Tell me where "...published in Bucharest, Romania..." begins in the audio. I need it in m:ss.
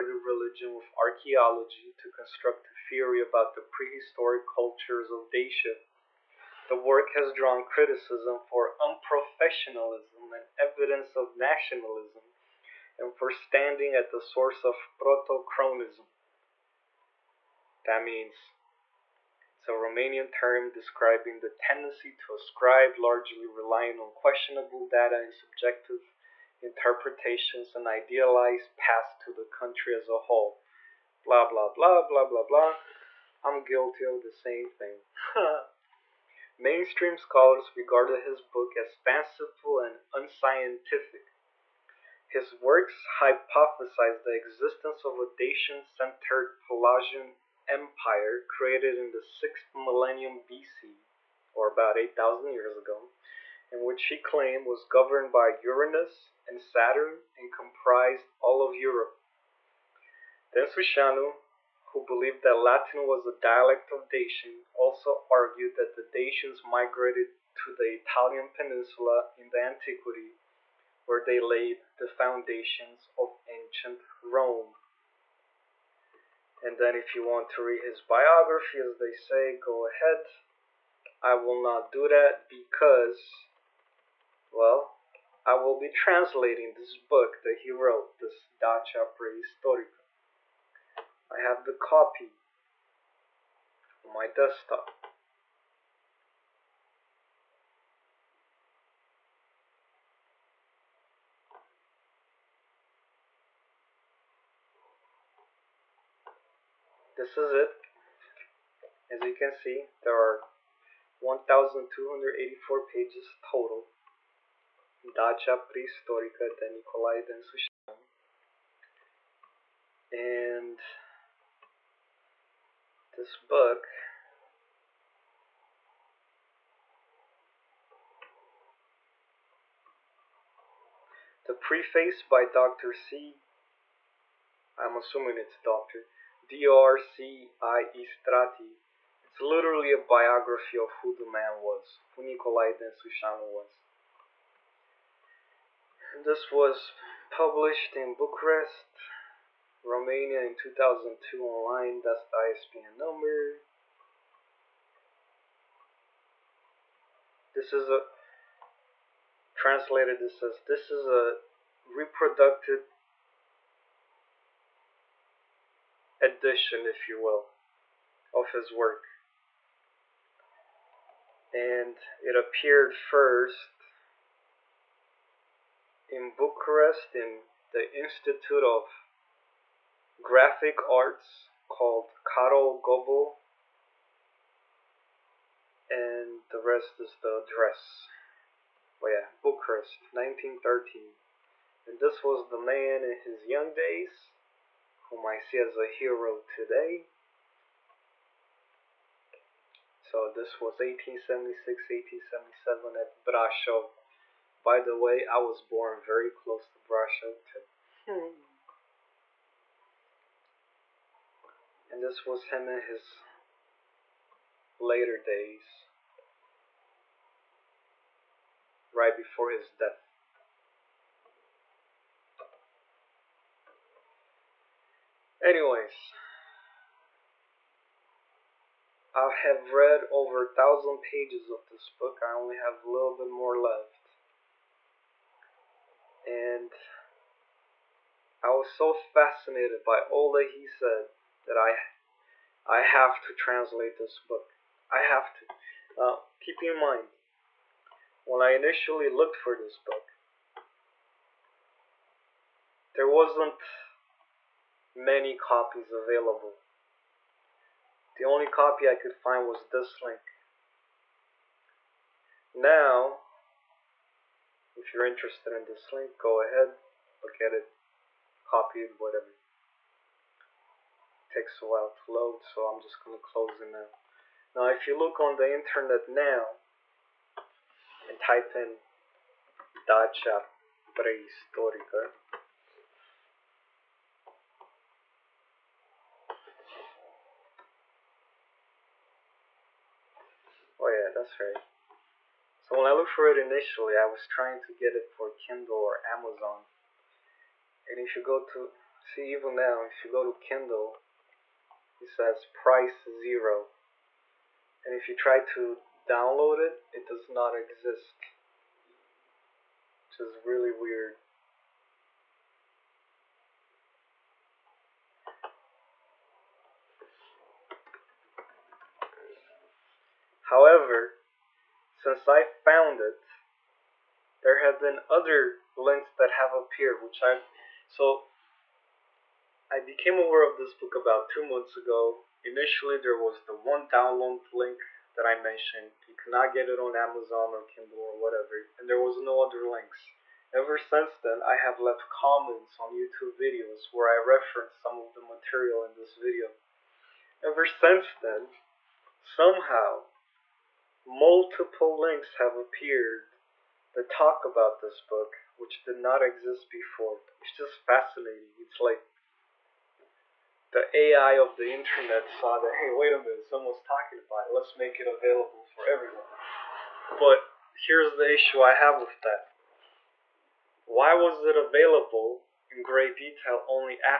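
2:27.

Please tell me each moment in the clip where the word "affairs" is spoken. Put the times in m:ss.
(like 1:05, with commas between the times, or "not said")
not said.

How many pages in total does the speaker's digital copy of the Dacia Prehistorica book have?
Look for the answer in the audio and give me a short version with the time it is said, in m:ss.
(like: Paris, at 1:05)
1284, at 1:51.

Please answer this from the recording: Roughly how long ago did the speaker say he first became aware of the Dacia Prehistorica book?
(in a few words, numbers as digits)
2 months.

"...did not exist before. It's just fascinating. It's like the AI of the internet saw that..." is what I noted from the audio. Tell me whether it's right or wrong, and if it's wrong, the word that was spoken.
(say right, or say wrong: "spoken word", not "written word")
right.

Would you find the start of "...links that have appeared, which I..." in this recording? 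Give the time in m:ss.
5:25.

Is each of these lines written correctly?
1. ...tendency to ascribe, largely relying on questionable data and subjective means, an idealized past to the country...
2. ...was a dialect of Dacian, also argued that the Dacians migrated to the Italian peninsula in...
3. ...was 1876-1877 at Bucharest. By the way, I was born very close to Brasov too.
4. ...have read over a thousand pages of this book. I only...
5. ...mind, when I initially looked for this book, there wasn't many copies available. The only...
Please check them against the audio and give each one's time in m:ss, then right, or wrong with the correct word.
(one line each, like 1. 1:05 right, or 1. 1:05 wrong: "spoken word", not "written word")
1. 0:21 wrong: "interpretations", not "means"
2. 1:03 right
3. 3:20 wrong: "Brasov", not "Bucharest"
4. 3:49 right
5. 4:06 right.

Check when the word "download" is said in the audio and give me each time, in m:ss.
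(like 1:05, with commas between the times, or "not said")
5:06, 5:33.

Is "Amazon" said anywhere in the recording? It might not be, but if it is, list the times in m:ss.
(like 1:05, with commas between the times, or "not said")
4:56, 5:36.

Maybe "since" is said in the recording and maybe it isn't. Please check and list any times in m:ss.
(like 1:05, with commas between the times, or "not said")
5:21, 5:40, 5:47.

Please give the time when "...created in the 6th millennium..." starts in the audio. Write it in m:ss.
0:48.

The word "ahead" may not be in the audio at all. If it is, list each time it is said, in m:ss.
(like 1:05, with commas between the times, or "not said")
1:19, 4:26.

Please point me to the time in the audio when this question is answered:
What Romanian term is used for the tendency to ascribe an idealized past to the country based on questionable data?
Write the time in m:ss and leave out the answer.
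0:14.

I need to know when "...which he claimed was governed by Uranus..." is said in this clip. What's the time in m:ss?
0:53.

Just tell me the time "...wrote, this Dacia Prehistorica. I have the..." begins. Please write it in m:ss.
1:27.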